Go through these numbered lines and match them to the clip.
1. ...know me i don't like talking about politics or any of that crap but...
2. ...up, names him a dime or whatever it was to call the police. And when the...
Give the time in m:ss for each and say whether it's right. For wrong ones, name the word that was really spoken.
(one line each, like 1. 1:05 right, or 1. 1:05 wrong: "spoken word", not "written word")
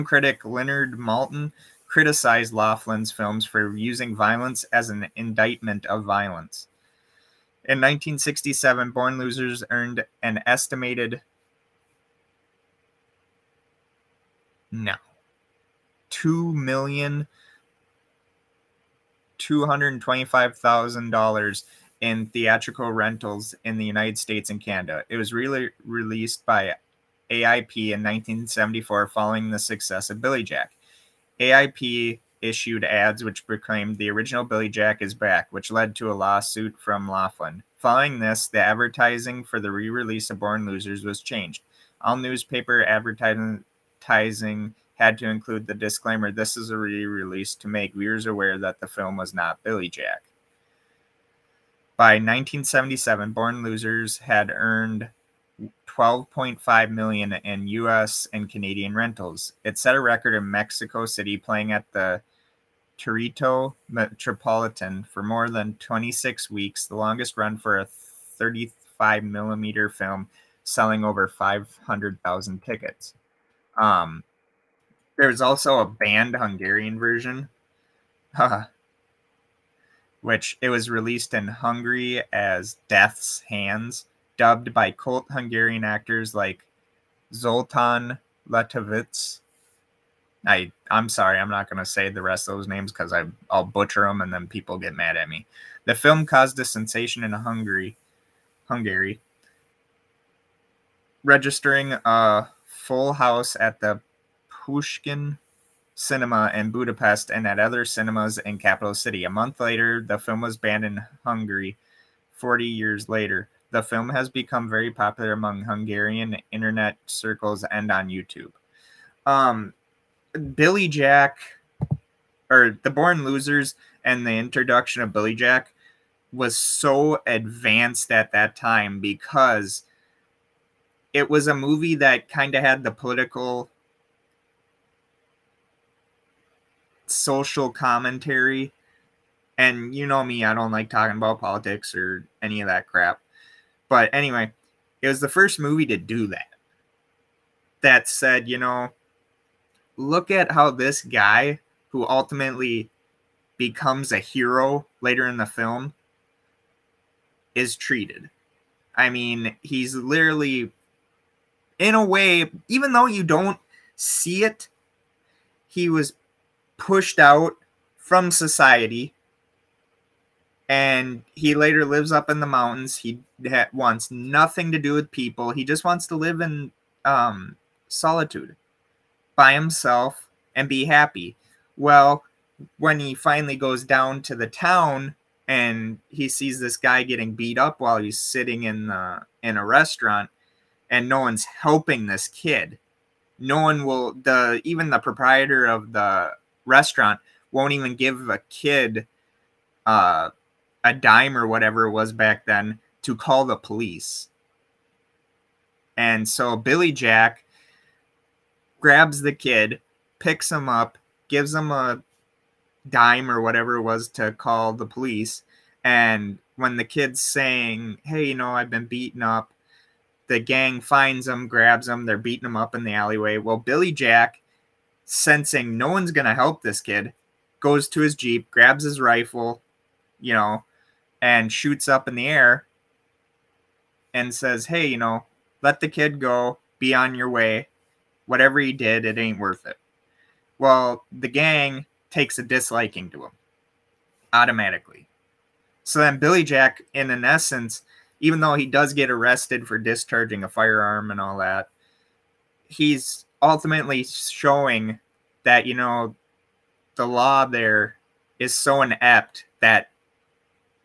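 1. 2:20 right
2. 3:30 wrong: "gives", not "names".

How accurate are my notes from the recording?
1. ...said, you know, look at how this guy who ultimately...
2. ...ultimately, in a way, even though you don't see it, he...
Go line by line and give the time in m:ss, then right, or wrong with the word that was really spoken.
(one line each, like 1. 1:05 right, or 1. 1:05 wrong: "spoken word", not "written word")
1. 2:28 right
2. 2:39 wrong: "literally", not "ultimately".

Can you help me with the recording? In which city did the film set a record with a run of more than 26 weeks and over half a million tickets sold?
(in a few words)
Mexico City.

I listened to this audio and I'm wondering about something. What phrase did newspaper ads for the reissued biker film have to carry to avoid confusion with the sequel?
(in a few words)
this is a re release.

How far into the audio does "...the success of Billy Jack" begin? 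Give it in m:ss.
0:29.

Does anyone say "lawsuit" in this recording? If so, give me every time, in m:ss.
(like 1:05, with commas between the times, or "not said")
0:36.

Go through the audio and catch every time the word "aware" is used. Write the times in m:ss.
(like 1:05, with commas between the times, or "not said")
0:48.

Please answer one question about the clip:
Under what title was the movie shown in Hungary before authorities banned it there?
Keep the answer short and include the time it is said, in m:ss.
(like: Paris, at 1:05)
Death's Hands, at 1:22.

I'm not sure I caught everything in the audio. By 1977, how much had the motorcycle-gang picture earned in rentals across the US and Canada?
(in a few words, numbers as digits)
$12.5 million.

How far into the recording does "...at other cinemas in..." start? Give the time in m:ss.
1:47.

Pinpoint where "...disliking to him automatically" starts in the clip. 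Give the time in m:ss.
4:02.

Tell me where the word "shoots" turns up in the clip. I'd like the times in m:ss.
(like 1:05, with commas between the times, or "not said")
3:51.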